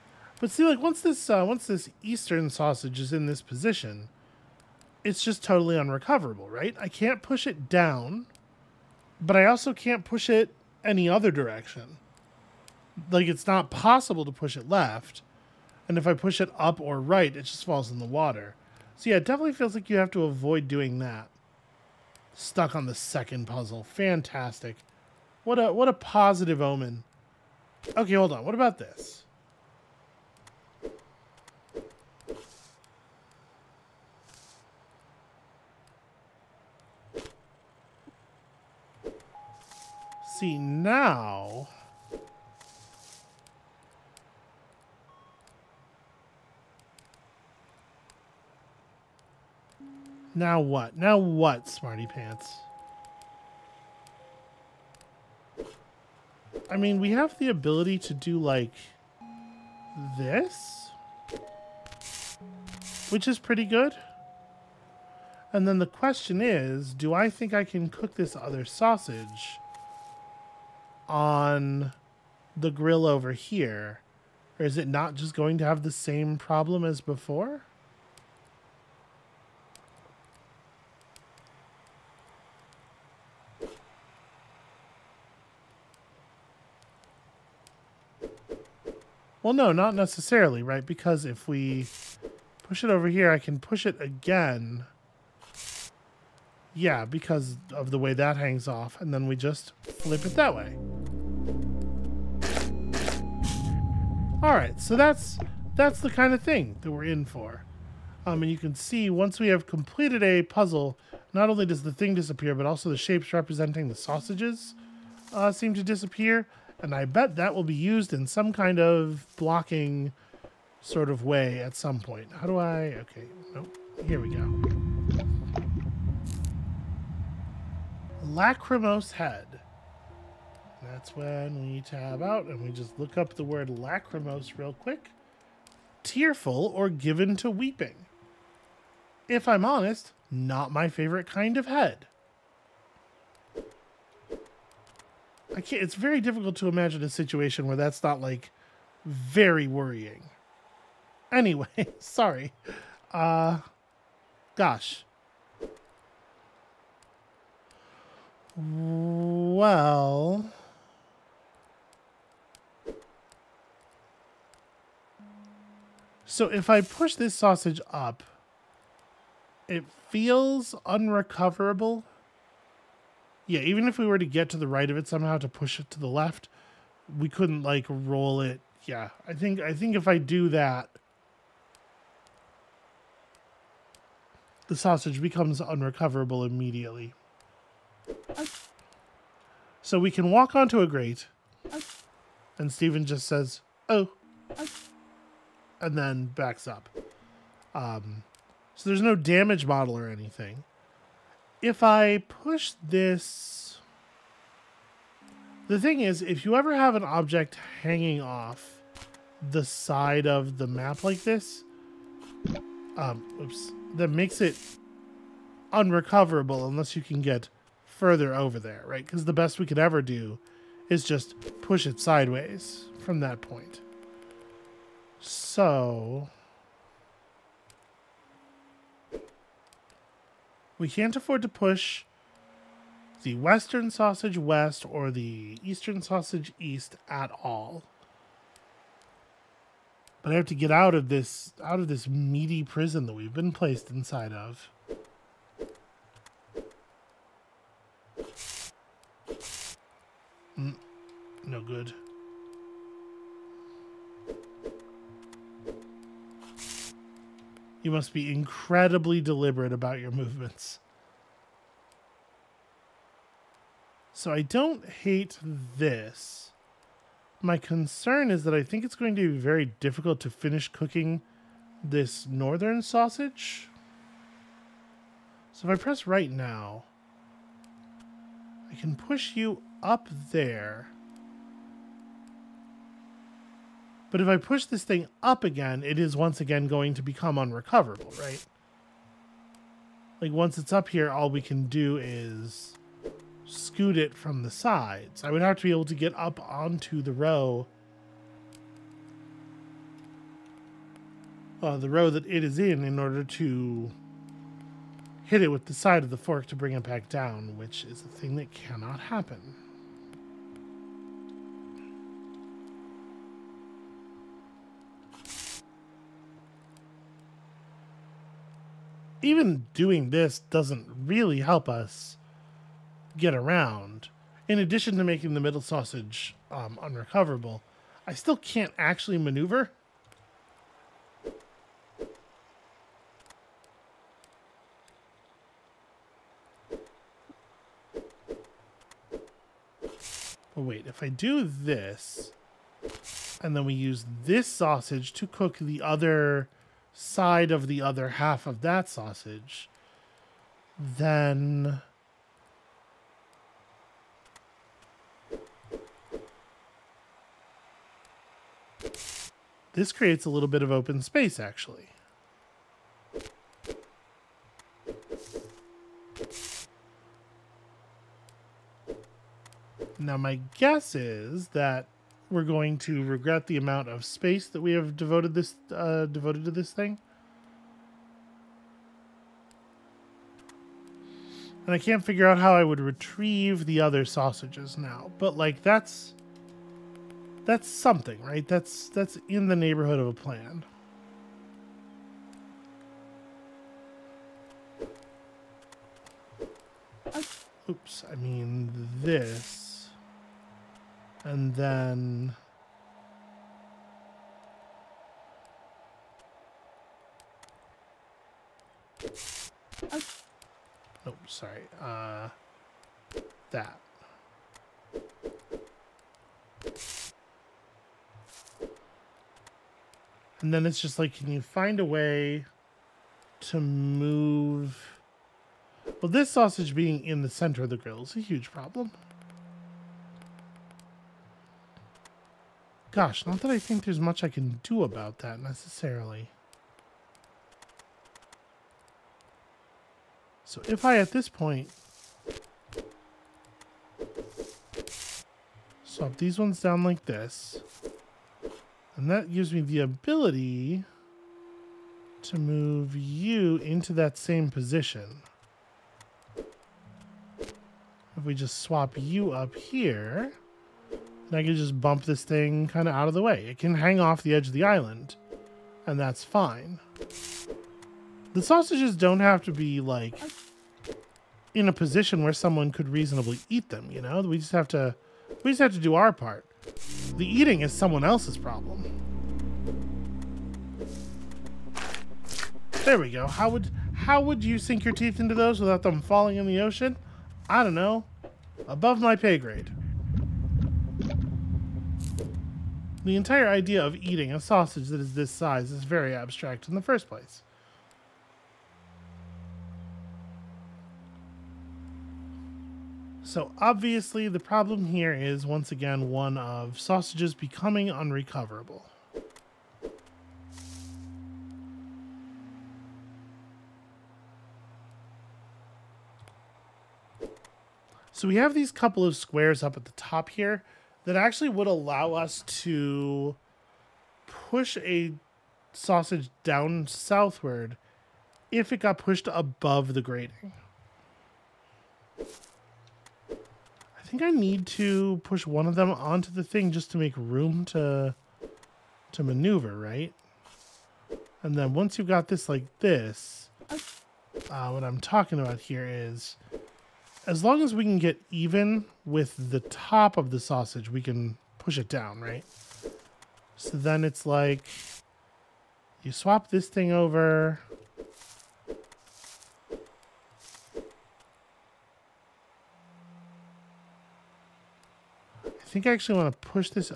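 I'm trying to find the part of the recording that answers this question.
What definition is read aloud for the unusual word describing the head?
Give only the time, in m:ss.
2:16.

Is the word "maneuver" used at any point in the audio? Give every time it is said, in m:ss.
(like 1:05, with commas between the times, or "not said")
5:29, 8:59.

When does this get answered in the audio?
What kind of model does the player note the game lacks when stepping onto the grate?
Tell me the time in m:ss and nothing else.
3:19.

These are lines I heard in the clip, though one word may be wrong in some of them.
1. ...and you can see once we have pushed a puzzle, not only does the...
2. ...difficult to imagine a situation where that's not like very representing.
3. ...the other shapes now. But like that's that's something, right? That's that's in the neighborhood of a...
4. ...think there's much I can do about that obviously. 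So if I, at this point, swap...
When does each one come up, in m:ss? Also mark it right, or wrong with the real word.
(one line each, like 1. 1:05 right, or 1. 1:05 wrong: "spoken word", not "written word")
1. 1:48 wrong: "completed", not "pushed"
2. 2:26 wrong: "worrying", not "representing"
3. 6:23 wrong: "sausages", not "shapes"
4. 7:13 wrong: "necessarily", not "obviously".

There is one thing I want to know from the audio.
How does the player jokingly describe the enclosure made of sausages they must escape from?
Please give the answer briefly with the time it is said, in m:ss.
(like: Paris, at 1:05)
Meaty prison, at 4:02.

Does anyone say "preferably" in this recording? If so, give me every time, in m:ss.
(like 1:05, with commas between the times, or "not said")
not said.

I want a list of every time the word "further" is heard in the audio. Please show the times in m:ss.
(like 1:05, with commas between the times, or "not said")
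3:37.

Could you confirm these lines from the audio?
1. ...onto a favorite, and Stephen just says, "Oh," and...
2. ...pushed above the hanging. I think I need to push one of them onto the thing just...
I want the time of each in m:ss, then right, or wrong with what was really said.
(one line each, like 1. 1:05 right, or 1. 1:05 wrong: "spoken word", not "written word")
1. 3:10 wrong: "grate", not "favorite"
2. 8:48 wrong: "grating", not "hanging".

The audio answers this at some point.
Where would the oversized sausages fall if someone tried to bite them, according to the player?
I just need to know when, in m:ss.
8:06.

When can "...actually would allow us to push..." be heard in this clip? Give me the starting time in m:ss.
8:41.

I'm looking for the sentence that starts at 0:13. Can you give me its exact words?
Like it's not possible to push it left, and if I push it up or right, it just falls in the water.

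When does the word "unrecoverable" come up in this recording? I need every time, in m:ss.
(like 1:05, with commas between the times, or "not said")
0:05, 2:50, 3:05, 3:35, 4:47, 5:26, 8:27.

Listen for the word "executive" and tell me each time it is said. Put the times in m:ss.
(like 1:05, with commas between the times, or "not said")
not said.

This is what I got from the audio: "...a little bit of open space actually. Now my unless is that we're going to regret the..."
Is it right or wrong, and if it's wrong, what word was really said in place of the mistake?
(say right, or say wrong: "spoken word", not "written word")
wrong: "guess", not "unless".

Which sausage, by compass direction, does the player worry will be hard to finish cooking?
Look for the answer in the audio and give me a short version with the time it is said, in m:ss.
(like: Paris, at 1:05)
Northern sausage, at 4:32.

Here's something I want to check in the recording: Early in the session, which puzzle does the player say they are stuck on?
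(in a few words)
The second puzzle.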